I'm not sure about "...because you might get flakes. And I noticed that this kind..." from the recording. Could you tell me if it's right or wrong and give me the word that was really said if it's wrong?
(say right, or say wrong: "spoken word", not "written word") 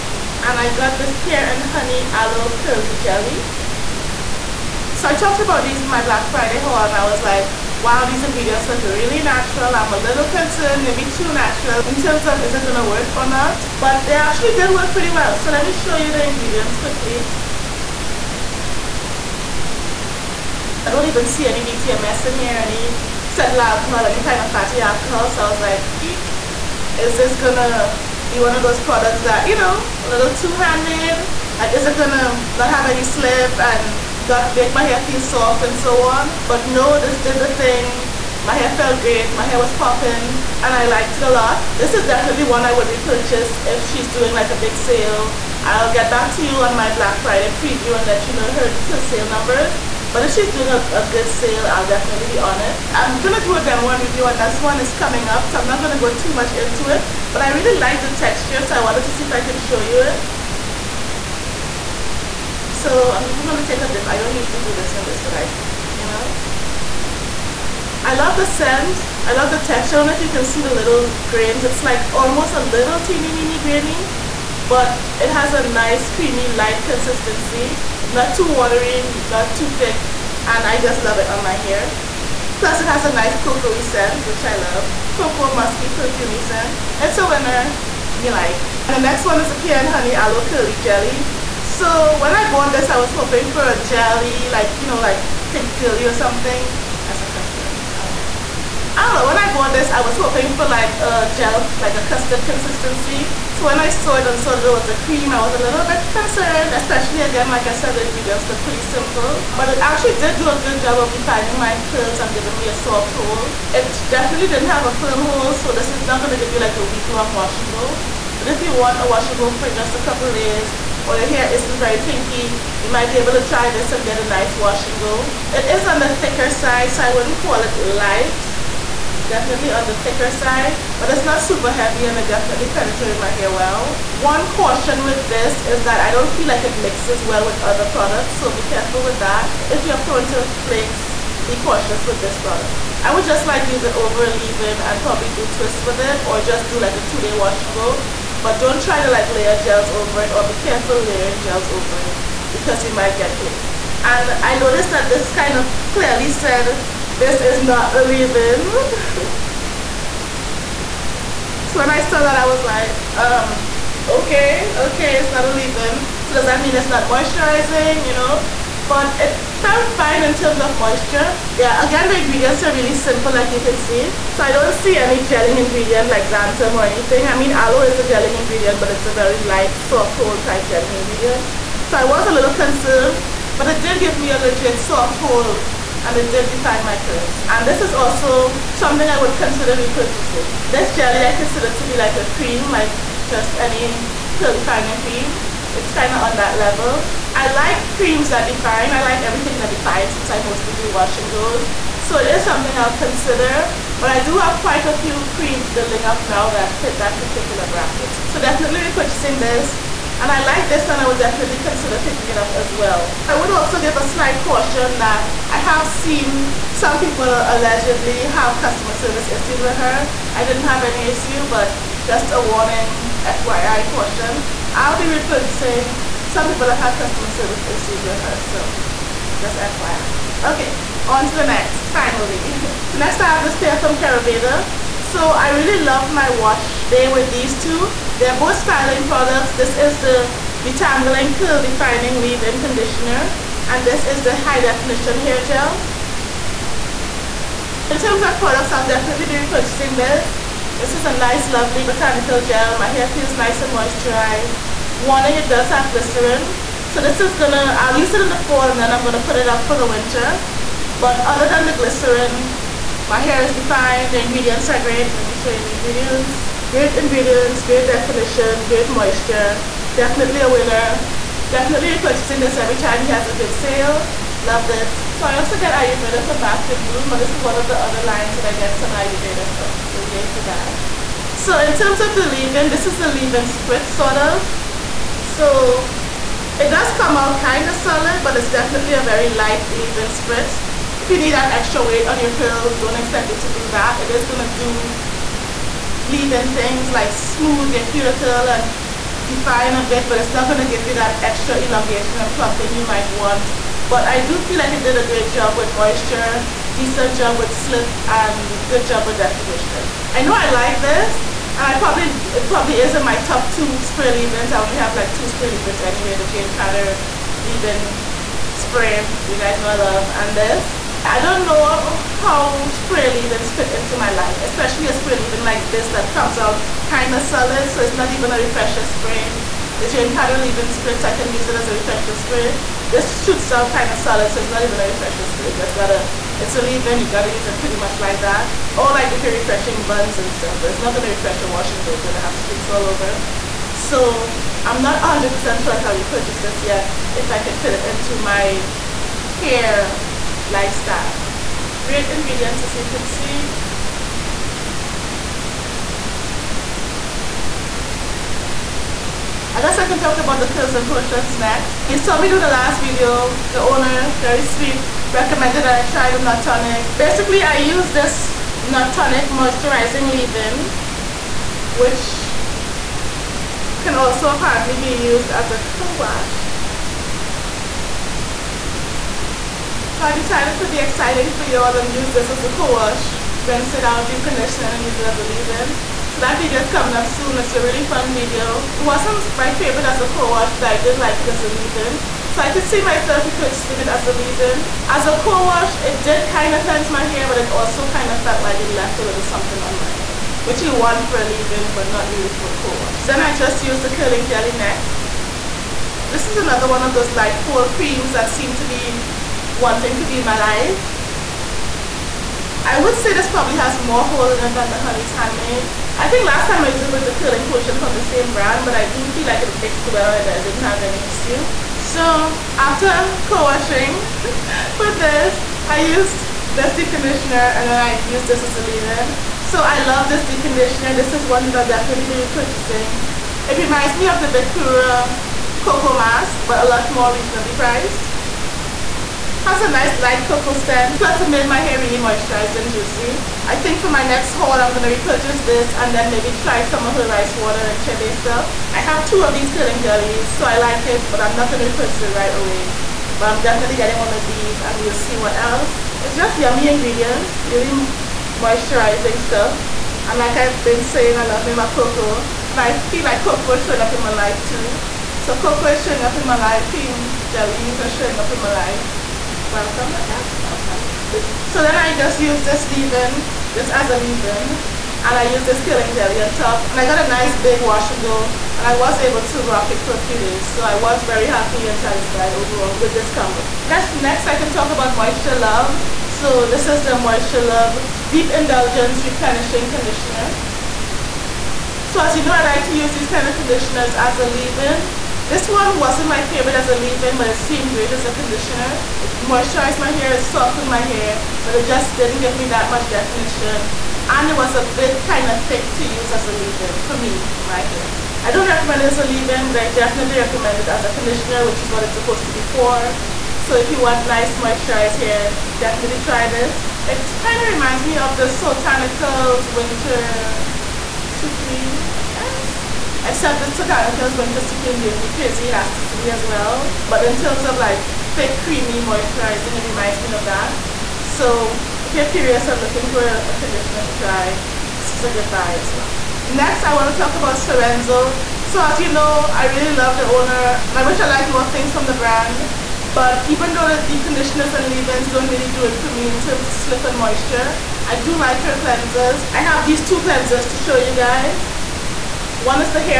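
right.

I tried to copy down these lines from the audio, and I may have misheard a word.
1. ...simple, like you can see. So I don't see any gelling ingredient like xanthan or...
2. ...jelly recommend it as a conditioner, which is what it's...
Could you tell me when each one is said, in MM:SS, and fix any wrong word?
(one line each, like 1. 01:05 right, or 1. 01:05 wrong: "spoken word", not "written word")
1. 02:52 right
2. 08:29 wrong: "definitely", not "jelly".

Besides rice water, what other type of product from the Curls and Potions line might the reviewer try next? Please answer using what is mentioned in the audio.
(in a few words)
Chebe.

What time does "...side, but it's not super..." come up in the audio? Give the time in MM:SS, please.
02:10.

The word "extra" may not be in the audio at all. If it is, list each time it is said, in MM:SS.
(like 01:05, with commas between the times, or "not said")
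04:51, 05:01.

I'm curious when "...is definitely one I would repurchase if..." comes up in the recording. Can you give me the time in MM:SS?
00:41.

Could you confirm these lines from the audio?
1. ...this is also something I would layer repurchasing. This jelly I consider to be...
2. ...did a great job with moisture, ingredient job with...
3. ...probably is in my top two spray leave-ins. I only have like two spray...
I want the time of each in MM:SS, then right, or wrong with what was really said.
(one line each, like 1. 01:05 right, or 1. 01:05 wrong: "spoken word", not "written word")
1. 03:07 wrong: "consider", not "layer"
2. 05:04 wrong: "decent", not "ingredient"
3. 05:12 right.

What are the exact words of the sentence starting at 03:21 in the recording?
So it is something I'll consider.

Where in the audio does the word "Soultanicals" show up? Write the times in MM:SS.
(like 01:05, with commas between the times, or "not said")
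08:38, 08:43.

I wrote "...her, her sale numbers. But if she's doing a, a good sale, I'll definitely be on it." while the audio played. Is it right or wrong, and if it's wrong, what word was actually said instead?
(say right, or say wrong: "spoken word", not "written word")
right.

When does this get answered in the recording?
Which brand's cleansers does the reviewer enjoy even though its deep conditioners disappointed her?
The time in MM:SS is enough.
08:57.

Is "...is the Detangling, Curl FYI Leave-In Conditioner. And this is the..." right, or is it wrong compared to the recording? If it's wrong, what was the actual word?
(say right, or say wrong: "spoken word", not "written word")
wrong: "Defining", not "FYI".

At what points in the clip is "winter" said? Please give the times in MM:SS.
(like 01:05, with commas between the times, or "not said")
04:19, 08:39, 08:44.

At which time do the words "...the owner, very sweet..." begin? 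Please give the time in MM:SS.
06:03.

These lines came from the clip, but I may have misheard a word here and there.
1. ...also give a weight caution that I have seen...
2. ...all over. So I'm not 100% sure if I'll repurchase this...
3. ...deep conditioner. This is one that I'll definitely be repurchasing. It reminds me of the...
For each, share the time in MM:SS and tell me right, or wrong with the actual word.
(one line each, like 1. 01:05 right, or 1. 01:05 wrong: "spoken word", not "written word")
1. 03:33 wrong: "slight", not "weight"
2. 05:42 right
3. 07:10 right.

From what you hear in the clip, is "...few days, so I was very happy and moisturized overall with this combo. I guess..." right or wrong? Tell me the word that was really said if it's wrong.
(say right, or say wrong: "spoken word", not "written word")
wrong: "satisfied", not "moisturized".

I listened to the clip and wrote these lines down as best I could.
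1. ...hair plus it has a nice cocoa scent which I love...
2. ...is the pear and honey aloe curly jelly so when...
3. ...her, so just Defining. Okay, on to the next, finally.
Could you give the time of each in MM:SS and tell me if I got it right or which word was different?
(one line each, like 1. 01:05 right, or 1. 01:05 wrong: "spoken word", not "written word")
1. 01:21 right
2. 01:29 right
3. 03:48 wrong: "FYI", not "Defining".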